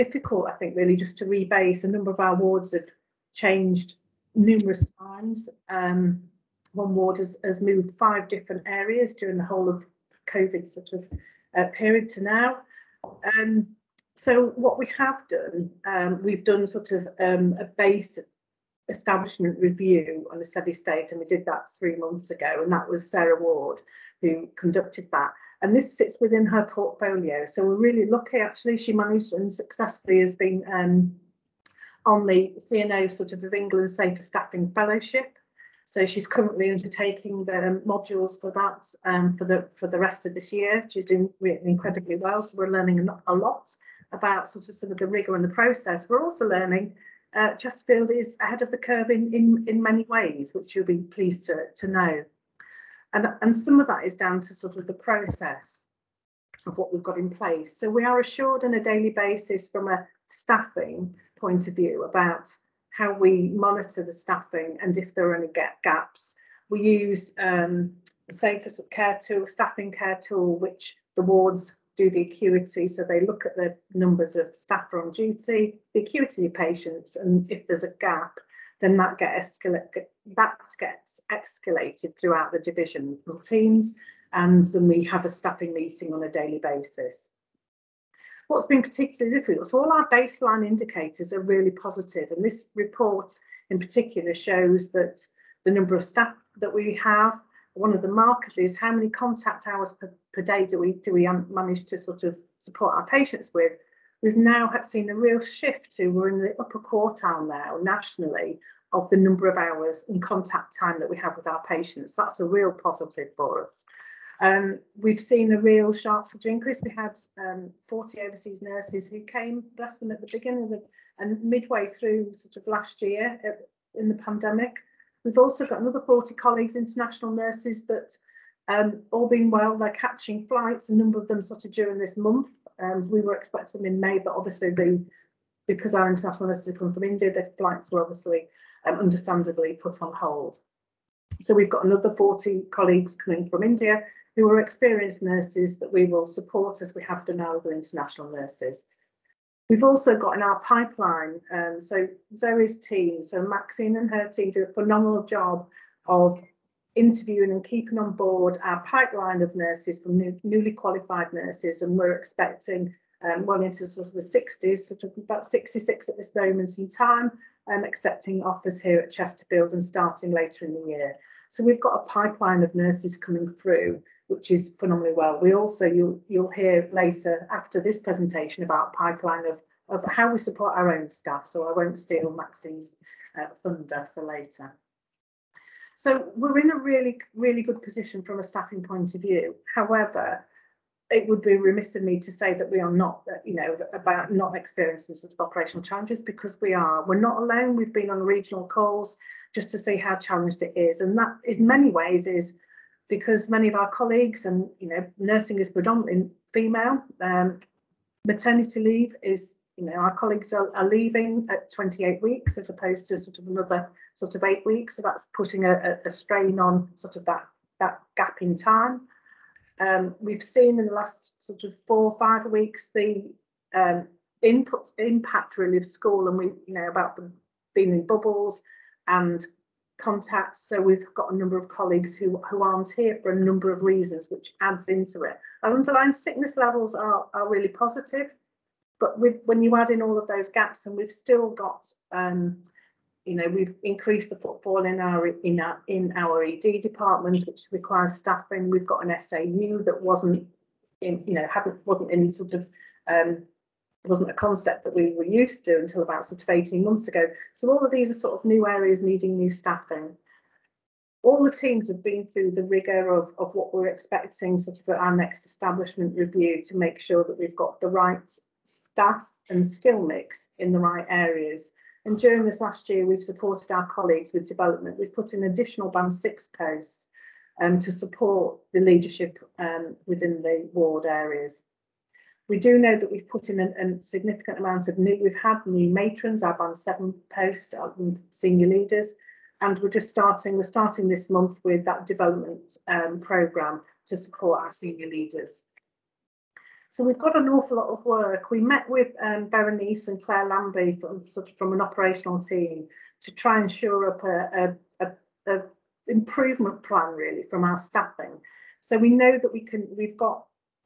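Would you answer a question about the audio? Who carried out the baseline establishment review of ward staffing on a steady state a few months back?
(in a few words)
Sarah Ward.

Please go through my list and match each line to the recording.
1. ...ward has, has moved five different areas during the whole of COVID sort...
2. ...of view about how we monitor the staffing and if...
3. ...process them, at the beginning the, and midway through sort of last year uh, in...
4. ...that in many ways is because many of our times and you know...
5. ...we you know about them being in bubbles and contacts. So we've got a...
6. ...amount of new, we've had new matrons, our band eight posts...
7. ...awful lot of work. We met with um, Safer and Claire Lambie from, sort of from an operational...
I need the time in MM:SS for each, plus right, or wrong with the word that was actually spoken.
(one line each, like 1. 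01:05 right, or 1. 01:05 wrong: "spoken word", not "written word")
1. 00:06 right
2. 01:01 right
3. 01:59 wrong: "bless", not "process"
4. 03:21 wrong: "colleagues", not "times"
5. 03:46 right
6. 04:44 wrong: "seven", not "eight"
7. 04:57 wrong: "Berenice", not "Safer".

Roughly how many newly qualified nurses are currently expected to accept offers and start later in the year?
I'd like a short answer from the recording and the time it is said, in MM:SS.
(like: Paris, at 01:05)
66, at 02:45.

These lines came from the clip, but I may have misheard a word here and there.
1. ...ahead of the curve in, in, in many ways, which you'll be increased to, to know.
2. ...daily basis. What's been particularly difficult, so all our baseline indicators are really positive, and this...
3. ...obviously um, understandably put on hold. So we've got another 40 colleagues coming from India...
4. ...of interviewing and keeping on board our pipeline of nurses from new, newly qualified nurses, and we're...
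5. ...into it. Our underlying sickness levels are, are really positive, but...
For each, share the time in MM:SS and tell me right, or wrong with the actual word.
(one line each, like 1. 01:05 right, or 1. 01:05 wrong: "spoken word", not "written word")
1. 00:48 wrong: "pleased", not "increased"
2. 01:26 right
3. 02:18 right
4. 02:36 right
5. 03:54 right.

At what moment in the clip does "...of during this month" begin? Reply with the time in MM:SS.
02:11.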